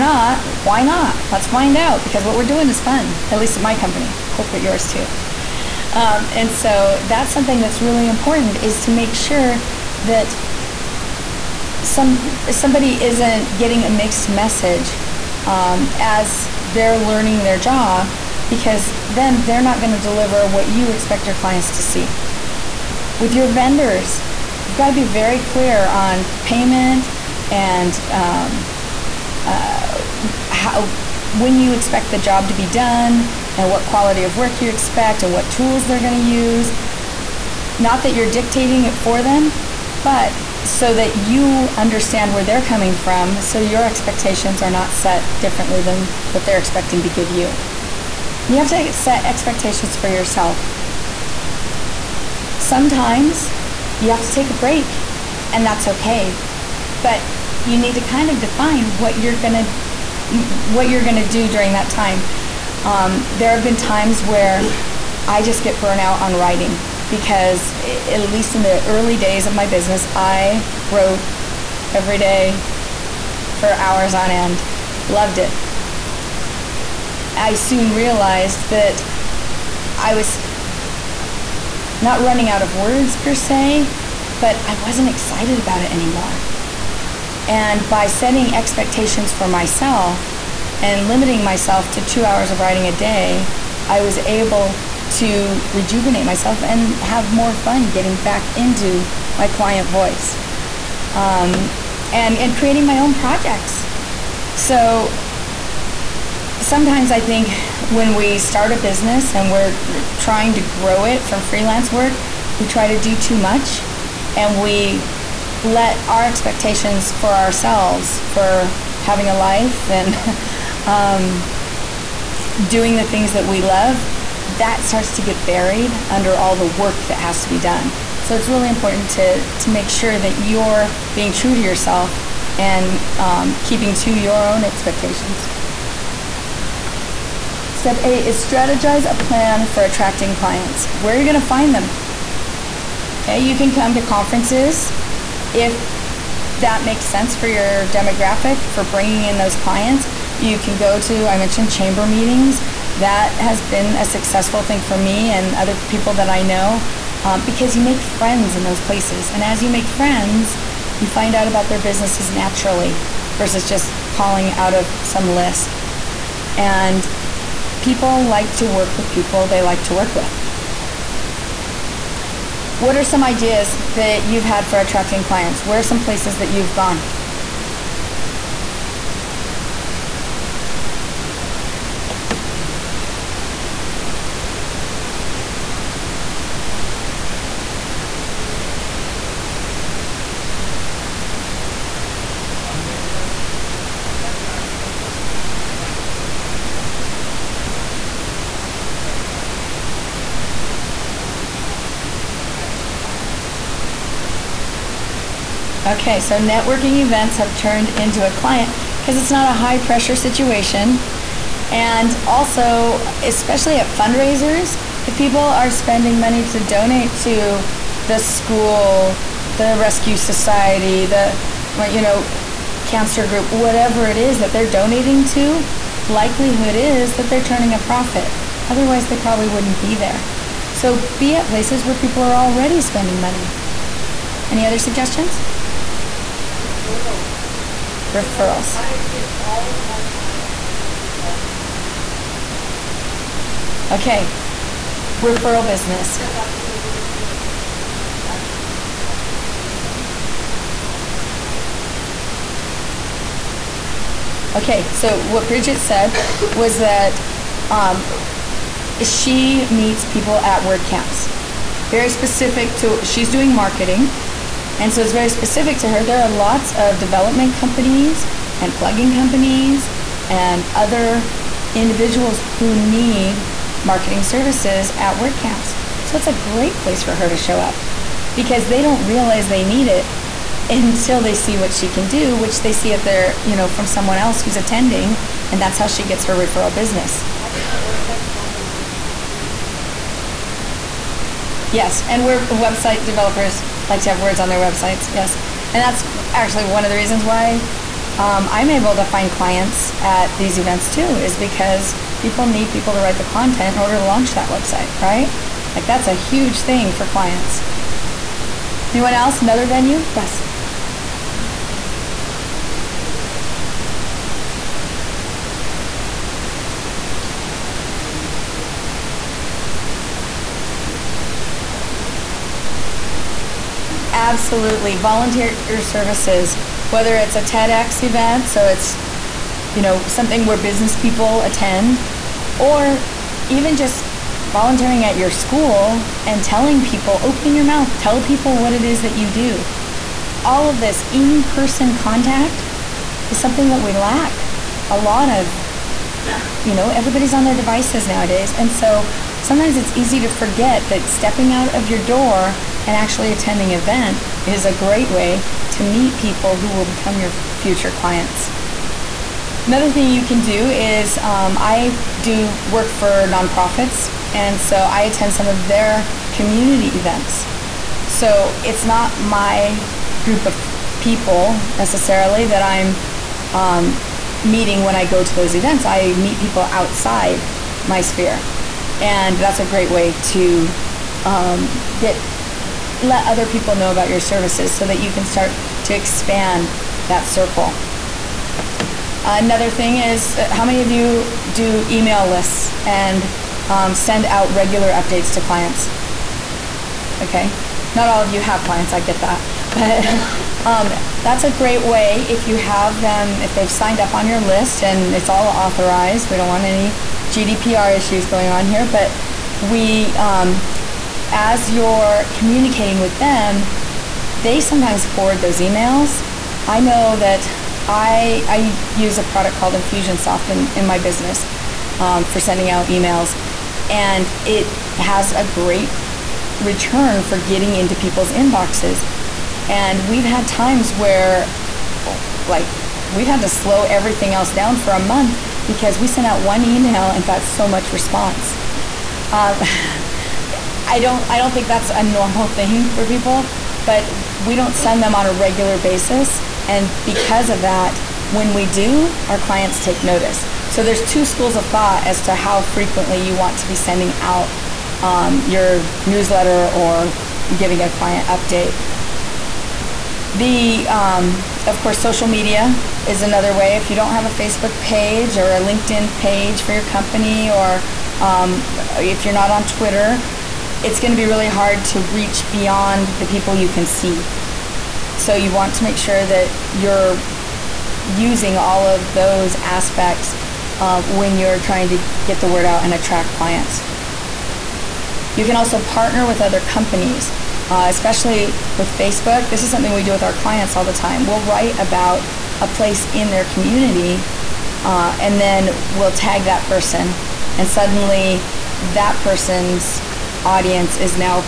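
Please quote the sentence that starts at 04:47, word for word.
Also, website developers like to have words on their websites.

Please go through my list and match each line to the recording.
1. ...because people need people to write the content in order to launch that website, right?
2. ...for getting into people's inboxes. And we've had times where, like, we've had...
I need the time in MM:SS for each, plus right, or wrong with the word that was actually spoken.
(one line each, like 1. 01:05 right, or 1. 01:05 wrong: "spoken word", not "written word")
1. 05:01 right
2. 07:07 right.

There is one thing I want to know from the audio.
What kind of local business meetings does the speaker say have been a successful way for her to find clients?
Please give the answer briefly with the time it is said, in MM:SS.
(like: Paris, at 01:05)
Chamber meetings, at 02:31.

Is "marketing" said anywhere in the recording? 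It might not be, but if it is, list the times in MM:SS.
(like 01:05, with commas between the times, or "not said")
04:23, 04:33.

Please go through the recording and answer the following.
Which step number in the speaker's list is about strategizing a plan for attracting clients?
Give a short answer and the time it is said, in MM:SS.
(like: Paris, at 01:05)
8, at 02:18.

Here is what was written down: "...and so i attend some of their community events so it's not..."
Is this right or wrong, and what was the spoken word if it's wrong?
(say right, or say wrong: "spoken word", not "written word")
right.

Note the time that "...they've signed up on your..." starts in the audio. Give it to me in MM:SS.
06:43.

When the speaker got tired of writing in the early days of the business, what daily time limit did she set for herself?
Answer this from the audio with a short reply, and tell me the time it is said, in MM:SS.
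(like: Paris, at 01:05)
2 hours, at 01:32.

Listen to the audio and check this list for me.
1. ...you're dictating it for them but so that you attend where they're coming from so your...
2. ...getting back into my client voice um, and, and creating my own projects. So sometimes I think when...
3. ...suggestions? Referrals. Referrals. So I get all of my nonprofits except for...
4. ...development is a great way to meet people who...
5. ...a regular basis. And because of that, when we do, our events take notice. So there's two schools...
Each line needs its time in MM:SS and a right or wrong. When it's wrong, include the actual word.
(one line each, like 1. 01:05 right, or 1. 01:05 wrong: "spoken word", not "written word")
1. 00:38 wrong: "understand", not "attend"
2. 01:37 right
3. 03:54 wrong: "clients", not "nonprofits"
4. 05:53 wrong: "event", not "development"
5. 07:25 wrong: "clients", not "events".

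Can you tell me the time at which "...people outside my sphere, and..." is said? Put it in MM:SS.
06:16.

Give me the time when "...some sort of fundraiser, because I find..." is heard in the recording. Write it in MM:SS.
03:12.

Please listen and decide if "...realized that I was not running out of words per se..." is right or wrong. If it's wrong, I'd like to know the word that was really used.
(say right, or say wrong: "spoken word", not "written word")
right.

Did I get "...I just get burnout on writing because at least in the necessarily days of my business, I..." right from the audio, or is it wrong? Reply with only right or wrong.
wrong.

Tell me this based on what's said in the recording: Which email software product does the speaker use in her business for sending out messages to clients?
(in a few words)
Infusionsoft.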